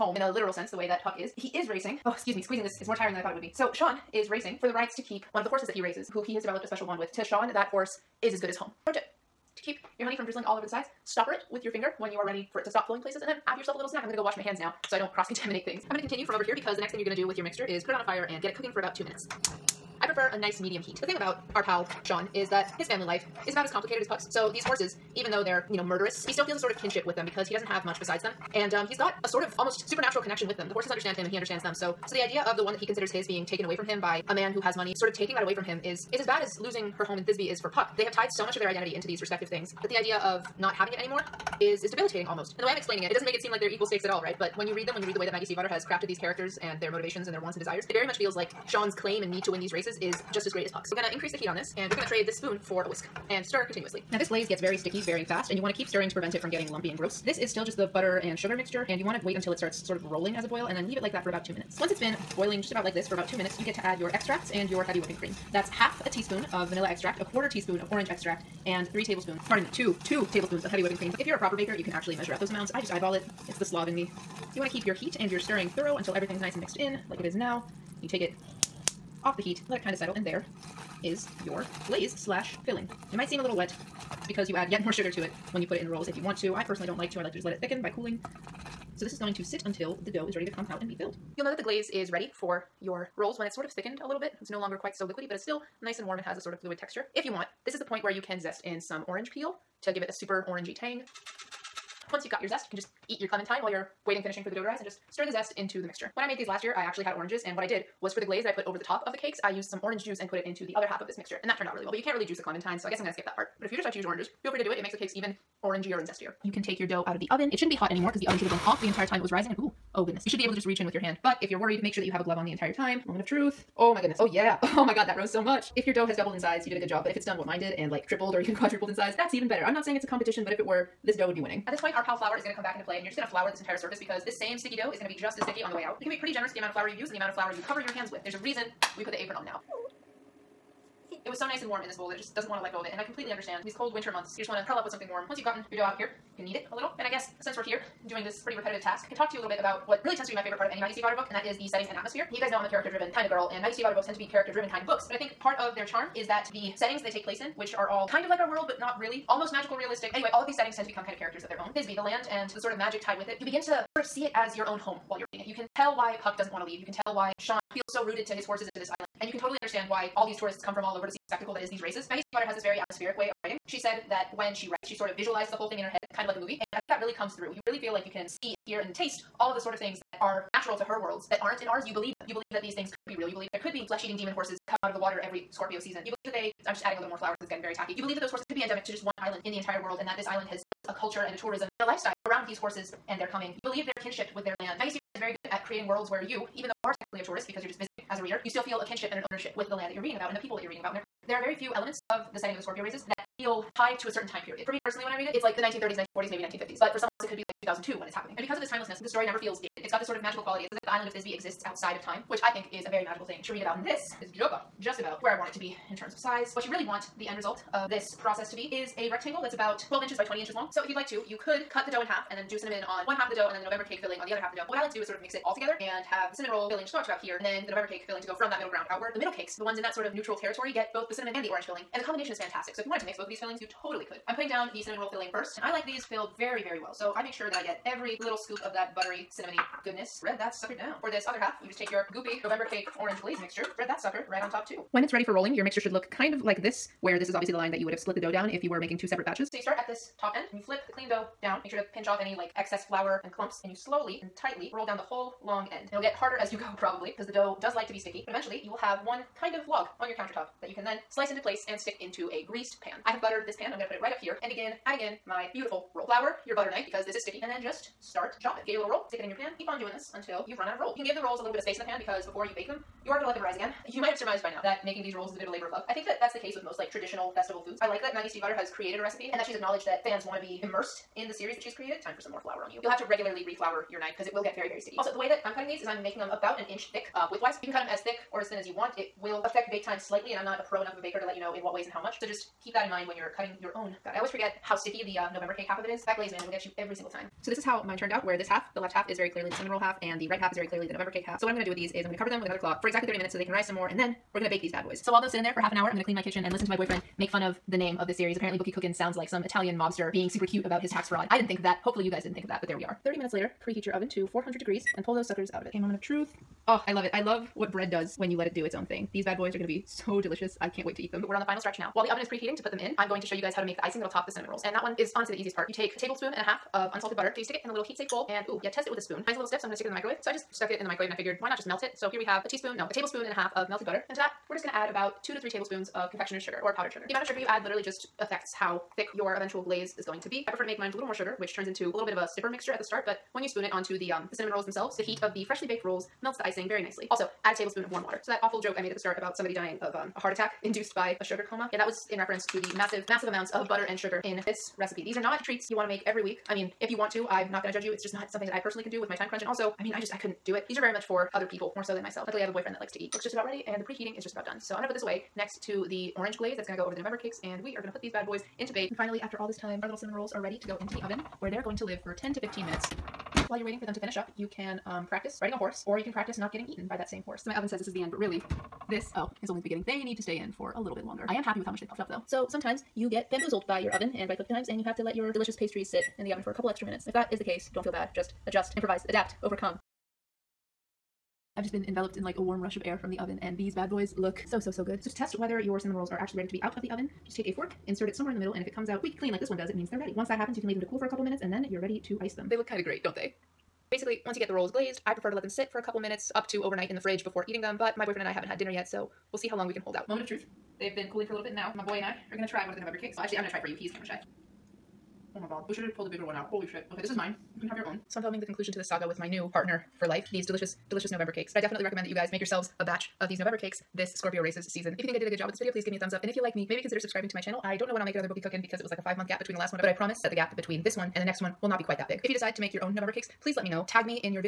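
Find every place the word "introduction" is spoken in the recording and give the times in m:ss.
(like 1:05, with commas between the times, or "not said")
not said.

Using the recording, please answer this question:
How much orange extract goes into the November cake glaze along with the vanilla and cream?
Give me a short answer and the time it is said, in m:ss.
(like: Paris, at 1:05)
1/4 teaspoon, at 1:07.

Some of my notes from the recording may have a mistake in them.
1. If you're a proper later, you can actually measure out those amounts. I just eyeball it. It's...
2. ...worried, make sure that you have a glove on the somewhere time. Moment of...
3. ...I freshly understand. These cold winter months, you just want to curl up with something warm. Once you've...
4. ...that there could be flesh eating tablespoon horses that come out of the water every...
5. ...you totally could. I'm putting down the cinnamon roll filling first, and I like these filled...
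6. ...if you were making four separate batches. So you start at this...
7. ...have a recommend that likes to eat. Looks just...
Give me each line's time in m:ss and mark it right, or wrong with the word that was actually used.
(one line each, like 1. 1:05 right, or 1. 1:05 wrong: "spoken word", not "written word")
1. 1:11 wrong: "baker", not "later"
2. 2:01 wrong: "entire", not "somewhere"
3. 2:22 wrong: "completely", not "freshly"
4. 3:03 wrong: "demon", not "tablespoon"
5. 3:53 right
6. 4:08 wrong: "two", not "four"
7. 6:02 wrong: "boyfriend", not "recommend".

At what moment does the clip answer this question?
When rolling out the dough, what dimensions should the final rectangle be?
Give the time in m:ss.
3:39.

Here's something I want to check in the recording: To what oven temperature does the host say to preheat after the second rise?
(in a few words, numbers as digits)
400 degrees.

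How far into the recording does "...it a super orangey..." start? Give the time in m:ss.
1:40.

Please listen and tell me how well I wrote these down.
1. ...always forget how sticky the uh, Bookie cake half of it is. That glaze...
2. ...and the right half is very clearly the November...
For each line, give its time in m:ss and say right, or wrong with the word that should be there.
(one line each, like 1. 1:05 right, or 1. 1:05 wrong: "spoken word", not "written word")
1. 4:54 wrong: "November", not "Bookie"
2. 5:00 right.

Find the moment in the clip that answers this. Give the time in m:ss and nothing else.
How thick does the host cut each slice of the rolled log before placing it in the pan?
4:46.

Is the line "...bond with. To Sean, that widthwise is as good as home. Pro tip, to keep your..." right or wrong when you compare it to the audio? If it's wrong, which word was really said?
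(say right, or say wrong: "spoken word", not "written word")
wrong: "horse", not "widthwise".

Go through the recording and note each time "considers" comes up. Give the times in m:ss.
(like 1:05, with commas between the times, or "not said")
0:32, 7:06.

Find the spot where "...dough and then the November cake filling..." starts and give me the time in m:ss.
3:43.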